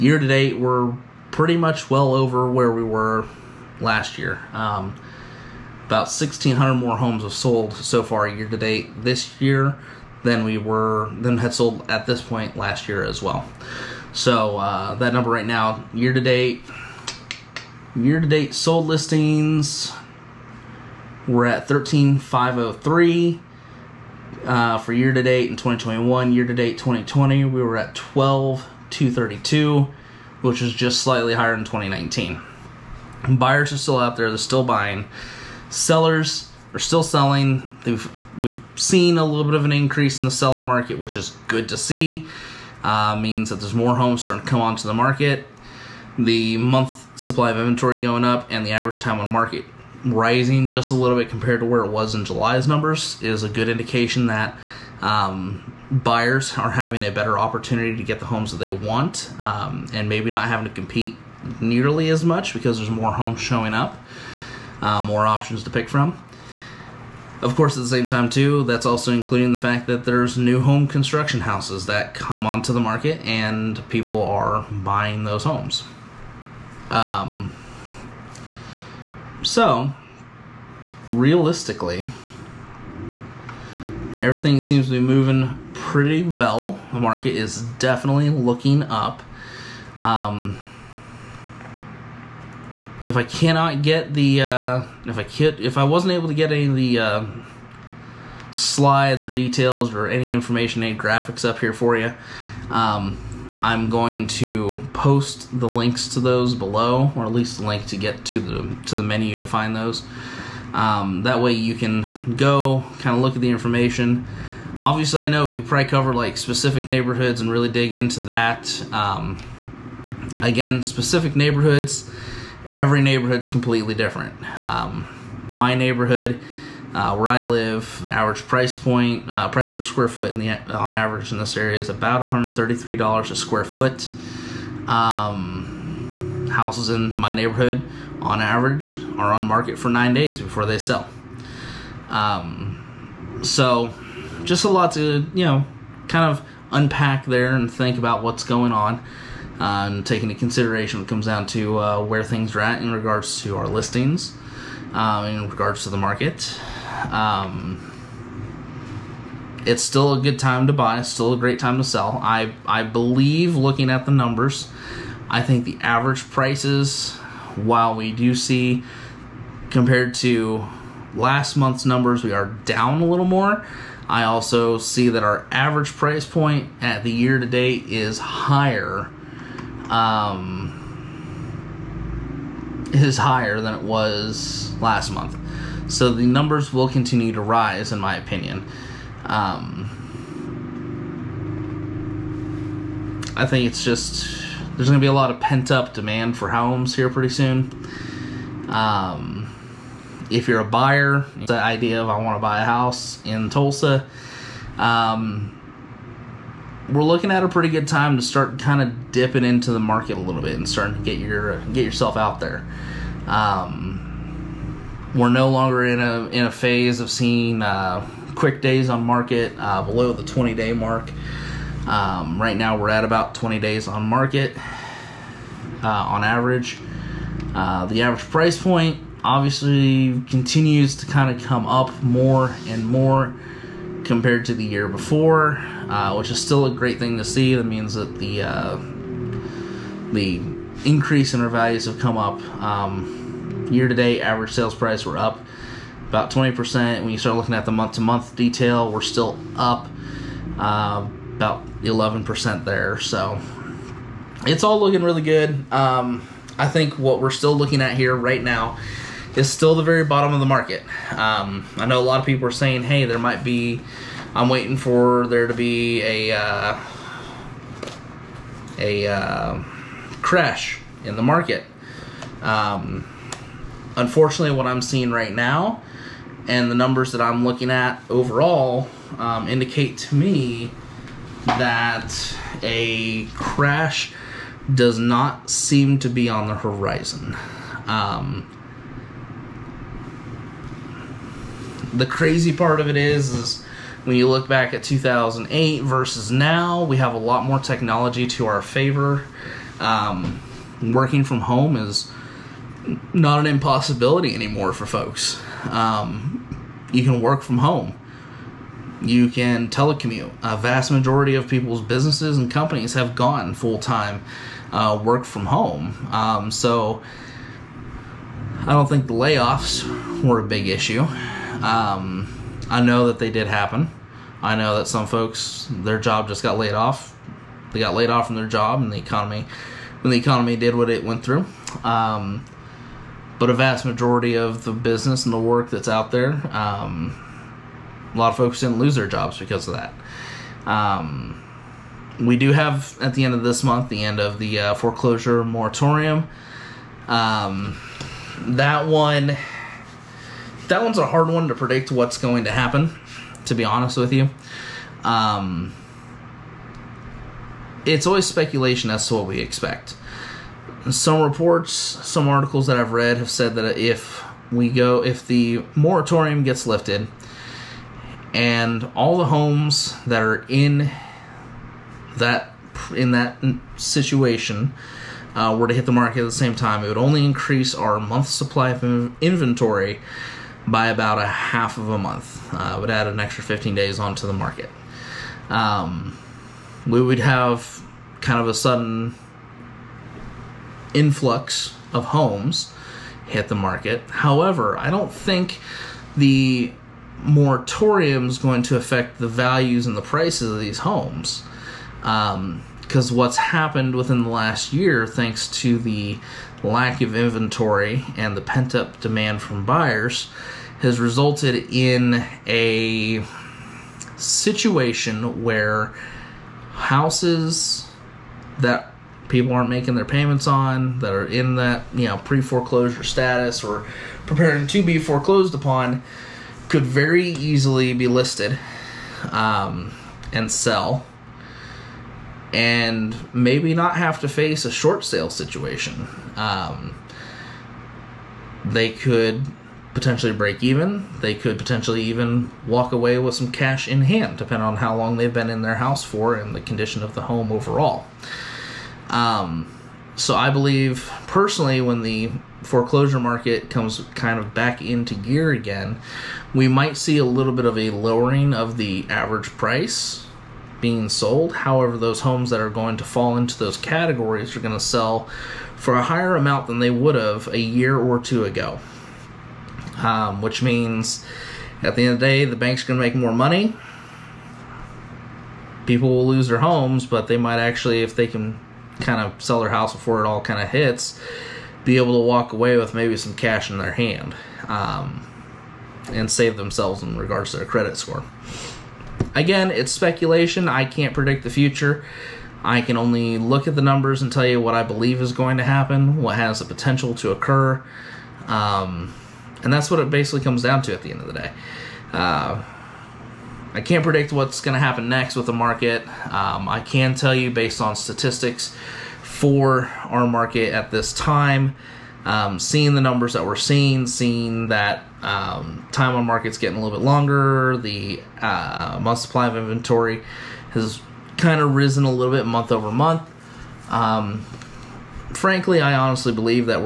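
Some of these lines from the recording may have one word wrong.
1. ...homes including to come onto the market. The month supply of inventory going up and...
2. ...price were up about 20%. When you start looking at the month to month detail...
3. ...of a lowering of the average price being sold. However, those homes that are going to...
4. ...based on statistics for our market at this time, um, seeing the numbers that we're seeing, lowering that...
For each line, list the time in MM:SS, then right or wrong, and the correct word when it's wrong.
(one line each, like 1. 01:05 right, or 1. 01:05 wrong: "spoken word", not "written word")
1. 00:43 wrong: "starting", not "including"
2. 04:04 right
3. 07:37 right
4. 08:27 wrong: "seeing", not "lowering".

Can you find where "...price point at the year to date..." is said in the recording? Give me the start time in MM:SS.
02:55.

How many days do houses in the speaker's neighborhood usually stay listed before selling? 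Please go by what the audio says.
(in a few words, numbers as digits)
9 days.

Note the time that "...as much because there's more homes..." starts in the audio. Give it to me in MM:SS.
01:02.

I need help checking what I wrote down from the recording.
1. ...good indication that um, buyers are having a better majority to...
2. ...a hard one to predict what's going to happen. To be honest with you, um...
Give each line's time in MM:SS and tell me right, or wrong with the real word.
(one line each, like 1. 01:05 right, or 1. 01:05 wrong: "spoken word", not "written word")
1. 00:53 wrong: "opportunity", not "majority"
2. 05:50 right.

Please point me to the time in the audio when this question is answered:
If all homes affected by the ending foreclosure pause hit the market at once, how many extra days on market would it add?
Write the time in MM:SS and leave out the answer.
06:23.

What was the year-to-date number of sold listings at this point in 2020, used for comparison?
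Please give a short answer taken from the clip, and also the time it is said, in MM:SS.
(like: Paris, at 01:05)
12,232, at 00:27.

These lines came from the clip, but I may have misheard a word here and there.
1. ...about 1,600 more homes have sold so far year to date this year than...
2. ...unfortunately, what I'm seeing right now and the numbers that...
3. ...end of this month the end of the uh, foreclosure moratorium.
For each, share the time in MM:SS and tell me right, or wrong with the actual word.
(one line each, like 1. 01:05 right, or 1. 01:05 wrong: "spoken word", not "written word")
1. 00:05 right
2. 04:33 right
3. 05:43 right.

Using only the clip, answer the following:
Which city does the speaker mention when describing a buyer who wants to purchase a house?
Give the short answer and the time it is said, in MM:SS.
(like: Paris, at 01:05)
Tulsa, at 03:23.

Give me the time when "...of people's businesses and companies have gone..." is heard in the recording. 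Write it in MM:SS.
05:11.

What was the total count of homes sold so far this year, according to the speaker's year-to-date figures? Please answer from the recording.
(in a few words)
13,503.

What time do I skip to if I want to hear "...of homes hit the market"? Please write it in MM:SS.
06:31.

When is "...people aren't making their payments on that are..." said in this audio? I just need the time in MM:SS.
06:59.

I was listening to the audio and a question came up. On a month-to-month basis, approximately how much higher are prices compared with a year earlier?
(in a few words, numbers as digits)
11%.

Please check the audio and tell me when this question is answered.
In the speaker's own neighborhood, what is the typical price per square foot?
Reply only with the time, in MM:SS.
02:12.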